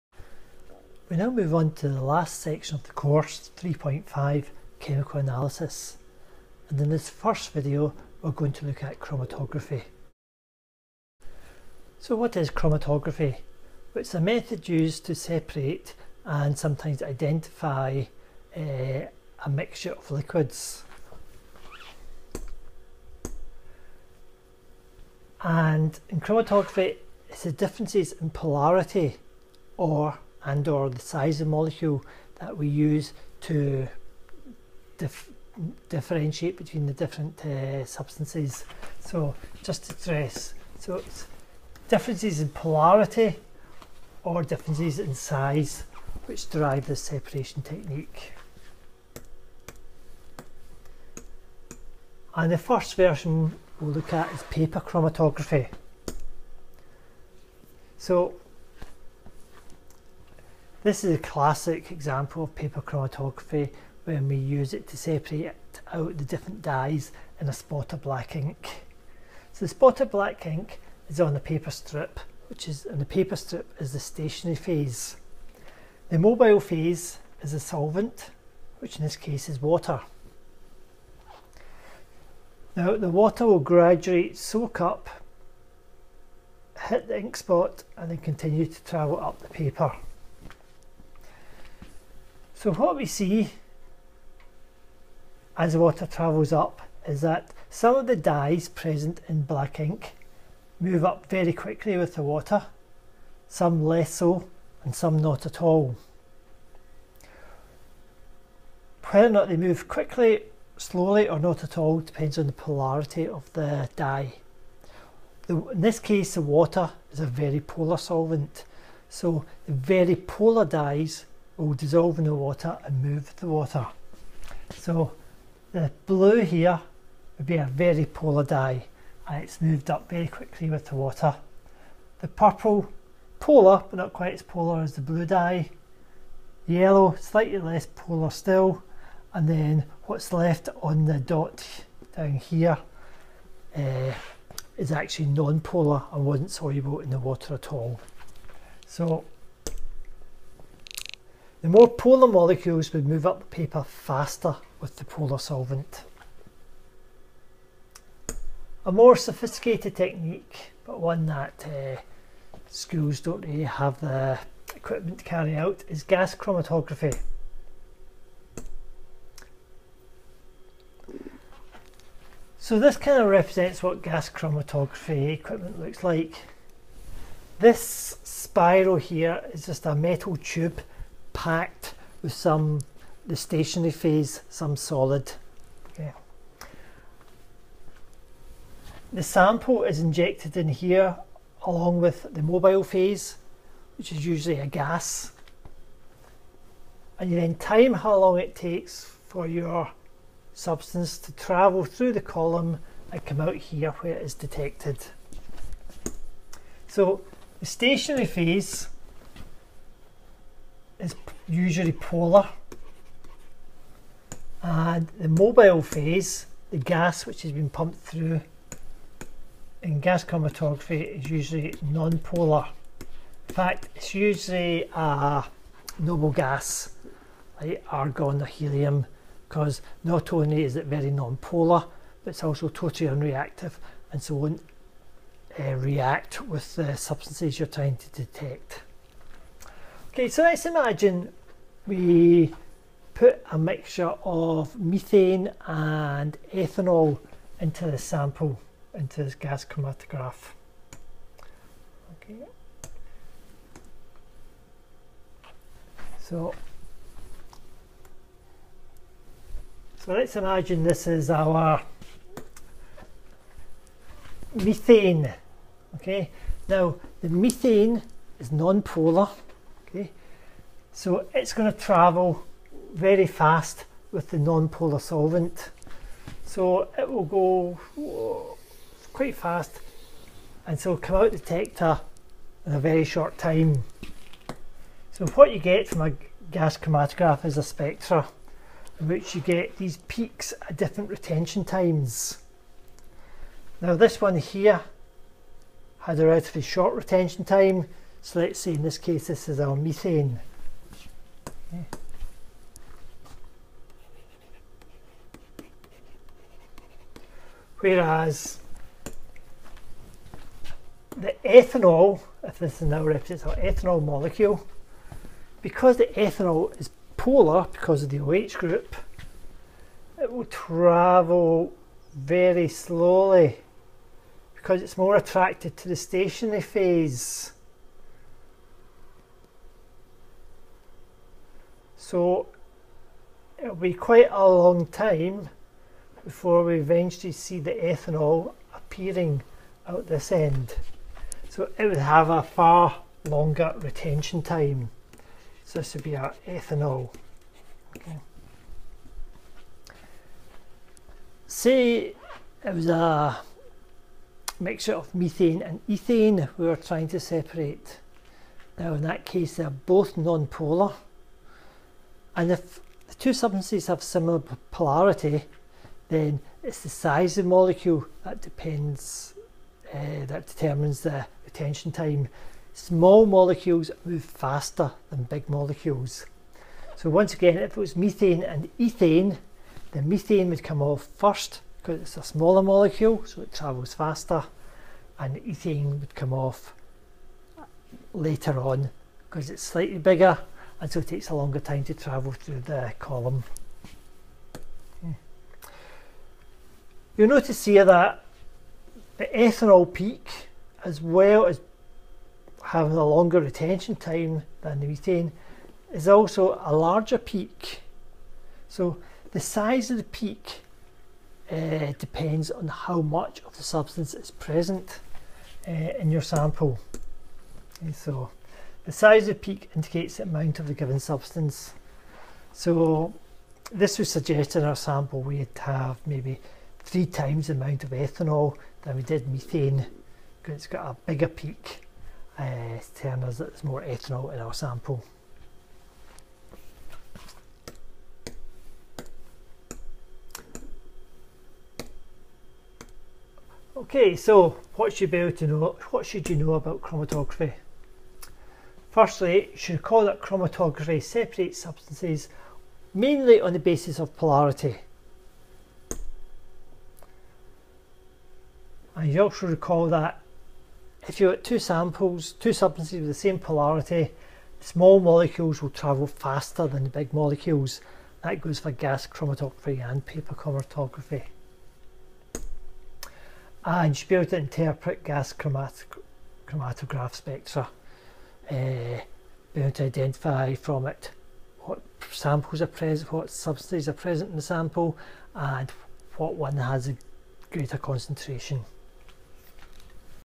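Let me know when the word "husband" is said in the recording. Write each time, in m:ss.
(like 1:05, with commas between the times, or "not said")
not said.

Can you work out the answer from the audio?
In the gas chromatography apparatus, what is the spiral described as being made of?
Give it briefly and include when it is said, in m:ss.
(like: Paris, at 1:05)
A metal tube, at 2:59.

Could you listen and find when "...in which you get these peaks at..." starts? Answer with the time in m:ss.
4:49.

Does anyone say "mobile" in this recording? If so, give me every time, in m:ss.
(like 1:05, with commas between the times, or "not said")
1:16, 3:12, 3:35.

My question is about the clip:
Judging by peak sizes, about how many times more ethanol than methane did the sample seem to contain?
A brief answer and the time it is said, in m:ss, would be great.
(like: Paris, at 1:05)
3, at 7:06.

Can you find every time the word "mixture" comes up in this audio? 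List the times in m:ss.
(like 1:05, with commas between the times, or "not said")
0:19, 4:03, 5:54.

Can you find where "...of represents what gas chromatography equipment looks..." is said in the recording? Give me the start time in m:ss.
2:53.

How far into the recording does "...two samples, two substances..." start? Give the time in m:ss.
7:41.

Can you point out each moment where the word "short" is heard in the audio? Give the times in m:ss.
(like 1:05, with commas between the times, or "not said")
4:43, 4:56.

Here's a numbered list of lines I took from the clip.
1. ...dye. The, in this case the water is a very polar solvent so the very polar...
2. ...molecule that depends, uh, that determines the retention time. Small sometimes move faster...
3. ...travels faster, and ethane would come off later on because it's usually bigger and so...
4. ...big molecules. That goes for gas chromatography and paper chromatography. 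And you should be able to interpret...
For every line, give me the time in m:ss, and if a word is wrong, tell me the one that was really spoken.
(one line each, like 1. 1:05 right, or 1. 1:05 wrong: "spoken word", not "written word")
1. 1:53 right
2. 6:07 wrong: "molecules", not "sometimes"
3. 6:23 wrong: "slightly", not "usually"
4. 7:46 right.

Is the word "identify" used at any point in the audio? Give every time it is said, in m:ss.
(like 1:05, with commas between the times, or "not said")
0:17, 7:59.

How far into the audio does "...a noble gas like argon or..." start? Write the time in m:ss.
3:44.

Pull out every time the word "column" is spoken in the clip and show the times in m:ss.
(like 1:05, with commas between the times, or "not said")
3:22, 6:32.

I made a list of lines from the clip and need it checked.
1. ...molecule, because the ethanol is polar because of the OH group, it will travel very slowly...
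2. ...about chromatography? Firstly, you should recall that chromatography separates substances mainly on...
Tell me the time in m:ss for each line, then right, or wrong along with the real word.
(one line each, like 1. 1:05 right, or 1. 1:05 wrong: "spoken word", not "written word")
1. 5:14 right
2. 7:26 right.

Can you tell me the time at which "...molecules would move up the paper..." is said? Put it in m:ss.
2:32.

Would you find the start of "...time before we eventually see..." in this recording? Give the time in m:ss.
5:34.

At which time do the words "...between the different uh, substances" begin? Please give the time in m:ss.
0:36.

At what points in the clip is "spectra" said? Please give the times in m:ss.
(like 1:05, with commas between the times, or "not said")
4:47, 7:57.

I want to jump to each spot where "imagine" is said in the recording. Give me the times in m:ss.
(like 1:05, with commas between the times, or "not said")
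4:00, 4:20.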